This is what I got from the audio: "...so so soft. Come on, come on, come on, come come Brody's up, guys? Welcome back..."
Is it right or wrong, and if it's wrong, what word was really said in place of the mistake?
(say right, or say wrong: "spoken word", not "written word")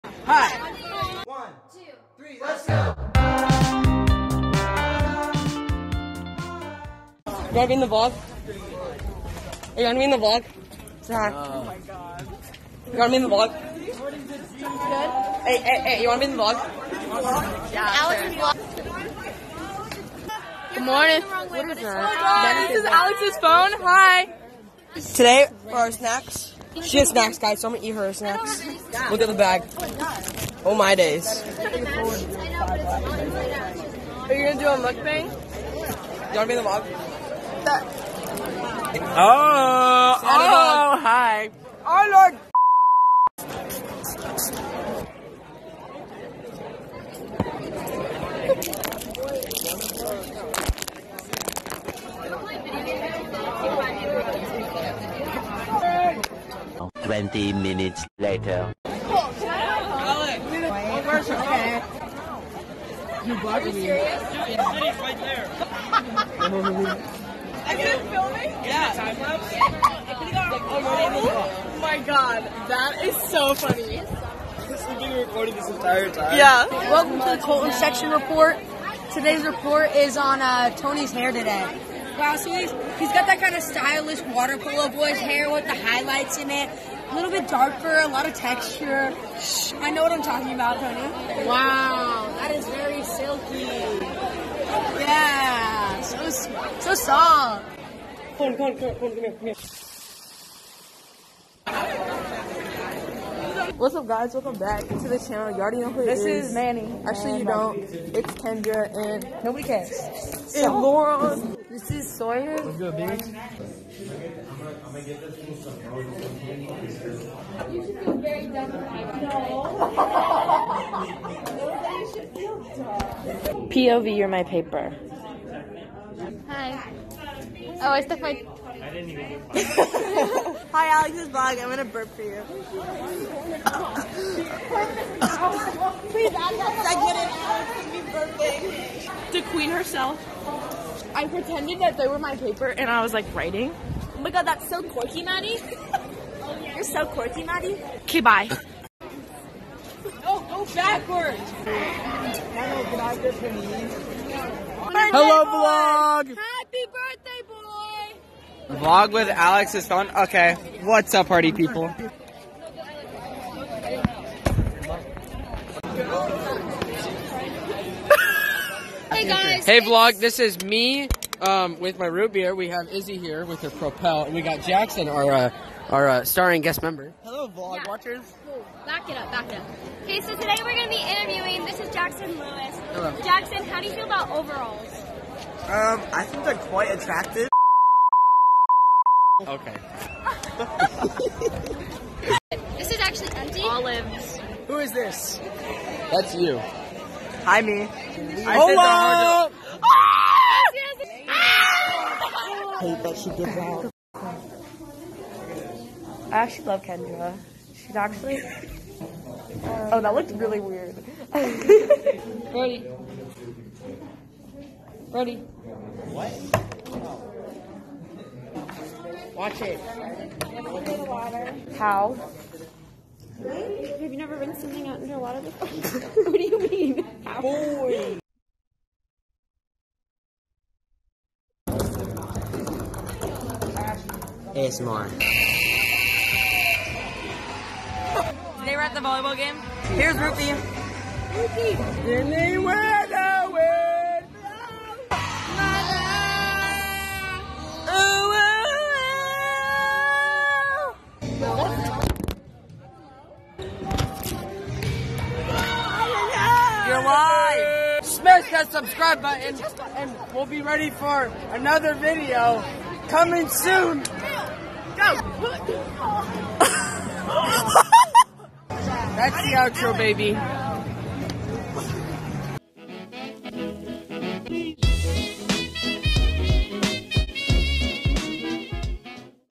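wrong: "What", not "Brody".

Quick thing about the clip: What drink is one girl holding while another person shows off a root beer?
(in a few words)
Propel.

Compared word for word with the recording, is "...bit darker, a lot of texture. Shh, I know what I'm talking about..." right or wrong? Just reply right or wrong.
right.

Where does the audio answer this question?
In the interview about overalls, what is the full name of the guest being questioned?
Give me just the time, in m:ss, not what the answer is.
3:01.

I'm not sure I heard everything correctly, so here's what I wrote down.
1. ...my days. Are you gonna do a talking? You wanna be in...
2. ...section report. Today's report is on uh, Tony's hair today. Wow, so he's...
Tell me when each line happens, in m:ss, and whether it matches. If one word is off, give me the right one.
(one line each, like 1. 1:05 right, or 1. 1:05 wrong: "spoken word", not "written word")
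1. 0:30 wrong: "mukbang", not "talking"
2. 1:17 right.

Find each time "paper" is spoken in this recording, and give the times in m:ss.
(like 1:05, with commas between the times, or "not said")
2:04, 2:22.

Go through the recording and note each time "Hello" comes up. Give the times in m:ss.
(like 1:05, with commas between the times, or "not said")
2:35, 2:57, 3:02.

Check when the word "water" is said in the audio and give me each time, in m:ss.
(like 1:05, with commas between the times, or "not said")
1:24, 3:45.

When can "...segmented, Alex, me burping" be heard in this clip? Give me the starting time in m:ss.
2:16.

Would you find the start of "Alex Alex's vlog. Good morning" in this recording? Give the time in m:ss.
0:17.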